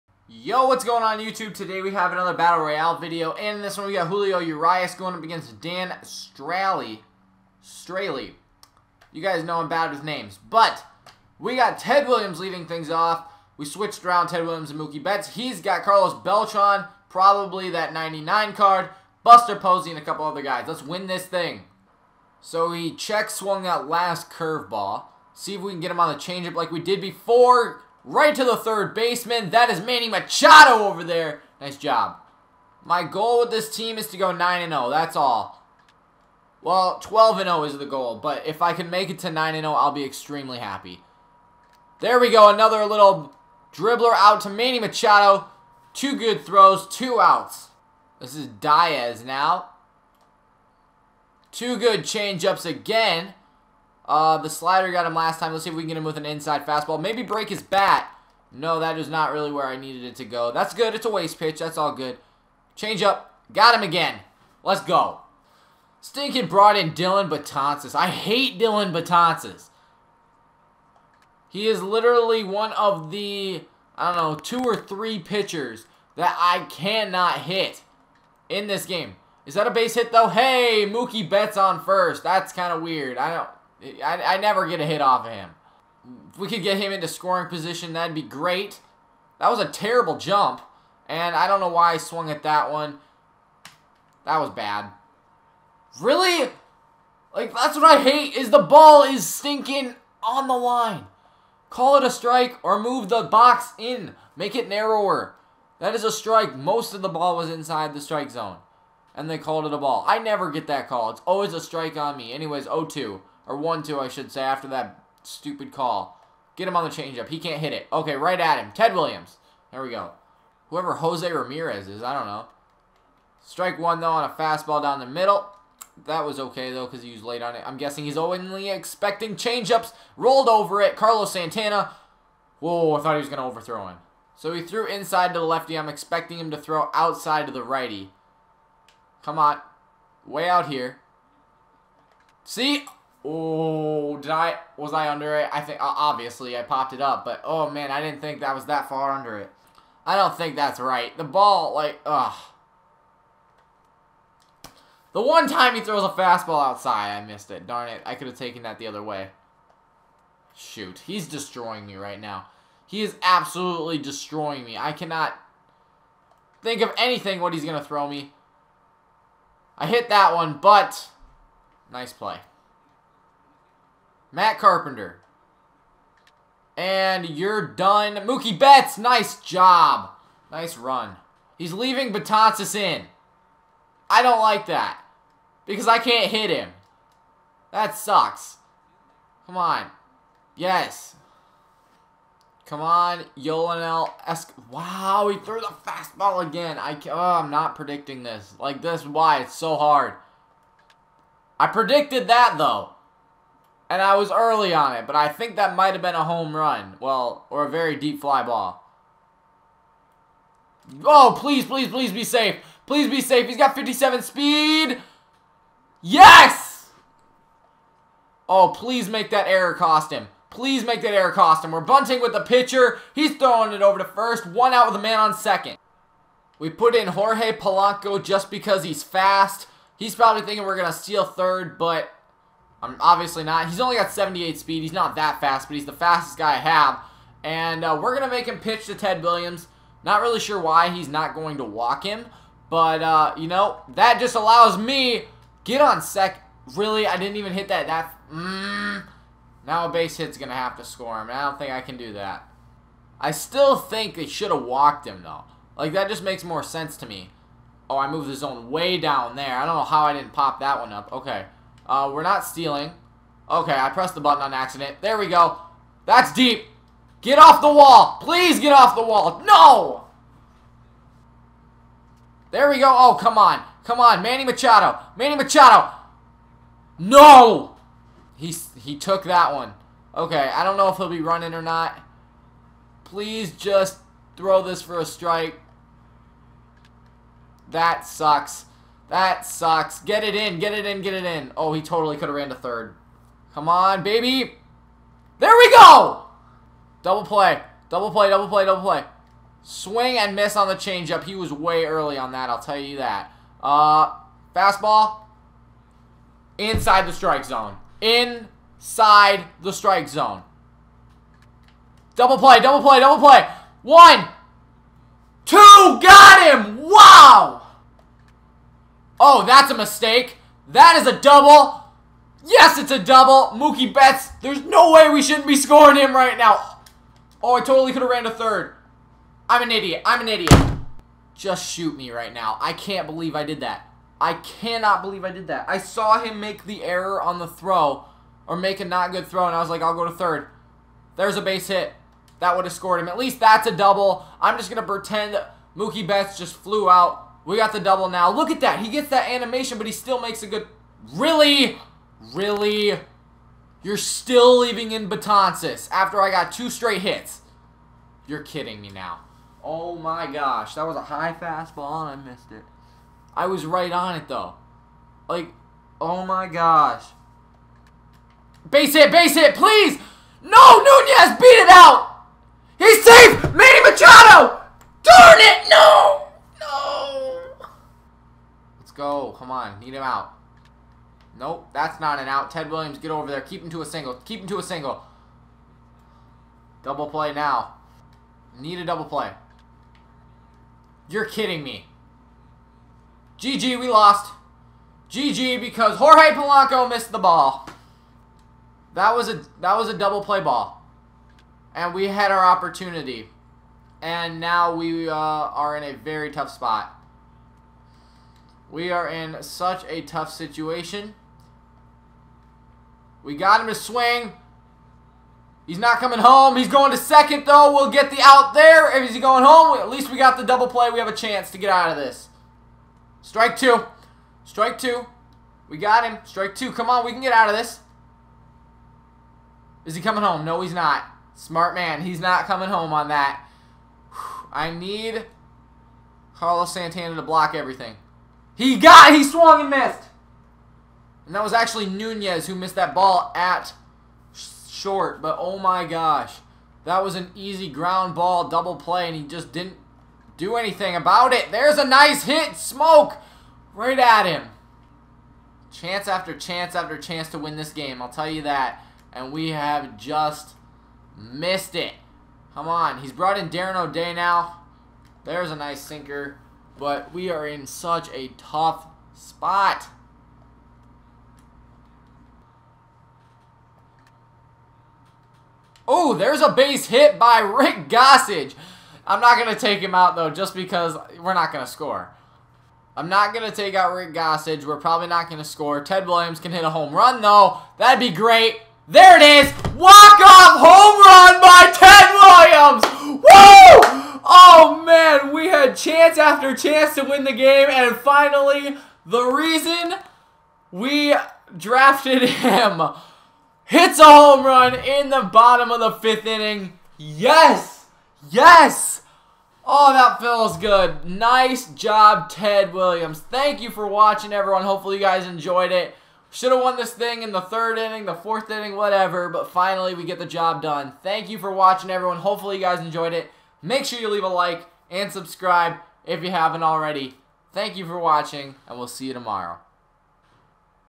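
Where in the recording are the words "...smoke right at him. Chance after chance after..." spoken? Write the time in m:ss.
7:32.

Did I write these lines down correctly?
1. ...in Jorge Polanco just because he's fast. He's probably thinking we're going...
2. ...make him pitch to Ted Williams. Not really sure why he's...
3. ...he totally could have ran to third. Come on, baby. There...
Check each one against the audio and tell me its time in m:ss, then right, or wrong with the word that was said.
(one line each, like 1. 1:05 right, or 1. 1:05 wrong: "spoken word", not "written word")
1. 3:46 right
2. 3:58 right
3. 4:51 right.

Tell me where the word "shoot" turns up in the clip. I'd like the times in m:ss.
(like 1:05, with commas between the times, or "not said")
2:40, 5:31.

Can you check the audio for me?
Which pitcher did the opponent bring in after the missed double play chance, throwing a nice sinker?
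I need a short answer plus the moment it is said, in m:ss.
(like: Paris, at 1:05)
Darren O'Day, at 7:43.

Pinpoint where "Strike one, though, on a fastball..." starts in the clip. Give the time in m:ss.
2:03.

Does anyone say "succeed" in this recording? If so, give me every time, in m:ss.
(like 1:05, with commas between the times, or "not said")
not said.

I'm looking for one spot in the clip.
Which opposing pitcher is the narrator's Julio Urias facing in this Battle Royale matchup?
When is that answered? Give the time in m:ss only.
0:05.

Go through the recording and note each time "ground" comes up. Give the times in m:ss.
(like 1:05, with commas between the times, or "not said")
7:27.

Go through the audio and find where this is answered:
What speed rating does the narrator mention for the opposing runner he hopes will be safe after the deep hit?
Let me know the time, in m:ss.
3:33.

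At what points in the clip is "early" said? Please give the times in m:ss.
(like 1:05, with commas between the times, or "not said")
3:24, 5:01.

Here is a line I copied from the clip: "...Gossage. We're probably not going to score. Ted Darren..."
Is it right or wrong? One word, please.
wrong.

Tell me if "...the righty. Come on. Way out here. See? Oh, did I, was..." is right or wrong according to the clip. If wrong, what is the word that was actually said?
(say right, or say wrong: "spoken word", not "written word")
right.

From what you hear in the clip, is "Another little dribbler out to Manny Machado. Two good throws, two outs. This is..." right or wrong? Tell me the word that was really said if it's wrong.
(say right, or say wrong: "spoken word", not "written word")
right.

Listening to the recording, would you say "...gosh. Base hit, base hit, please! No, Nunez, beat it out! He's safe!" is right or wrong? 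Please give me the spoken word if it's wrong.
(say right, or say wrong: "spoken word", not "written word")
right.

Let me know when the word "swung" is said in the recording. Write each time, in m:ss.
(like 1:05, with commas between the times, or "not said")
0:23, 1:31, 7:19.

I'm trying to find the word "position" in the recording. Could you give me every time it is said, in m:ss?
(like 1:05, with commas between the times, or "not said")
1:27.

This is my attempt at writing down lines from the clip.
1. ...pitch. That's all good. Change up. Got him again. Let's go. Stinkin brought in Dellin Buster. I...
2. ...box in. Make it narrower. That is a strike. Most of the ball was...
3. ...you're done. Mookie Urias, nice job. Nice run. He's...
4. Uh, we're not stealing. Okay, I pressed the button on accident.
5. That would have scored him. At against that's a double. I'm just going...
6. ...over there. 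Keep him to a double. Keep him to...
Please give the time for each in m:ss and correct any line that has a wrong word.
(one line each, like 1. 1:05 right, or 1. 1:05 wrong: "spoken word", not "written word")
1. 1:01 wrong: "Betances", not "Buster"
2. 1:43 right
3. 2:57 wrong: "Betts", not "Urias"
4. 4:21 right
5. 5:42 wrong: "least", not "against"
6. 6:23 wrong: "single", not "double".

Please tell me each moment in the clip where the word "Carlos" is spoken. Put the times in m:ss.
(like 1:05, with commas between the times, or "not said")
0:15, 2:10, 7:16.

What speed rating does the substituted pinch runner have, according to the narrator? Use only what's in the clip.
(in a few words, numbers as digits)
78.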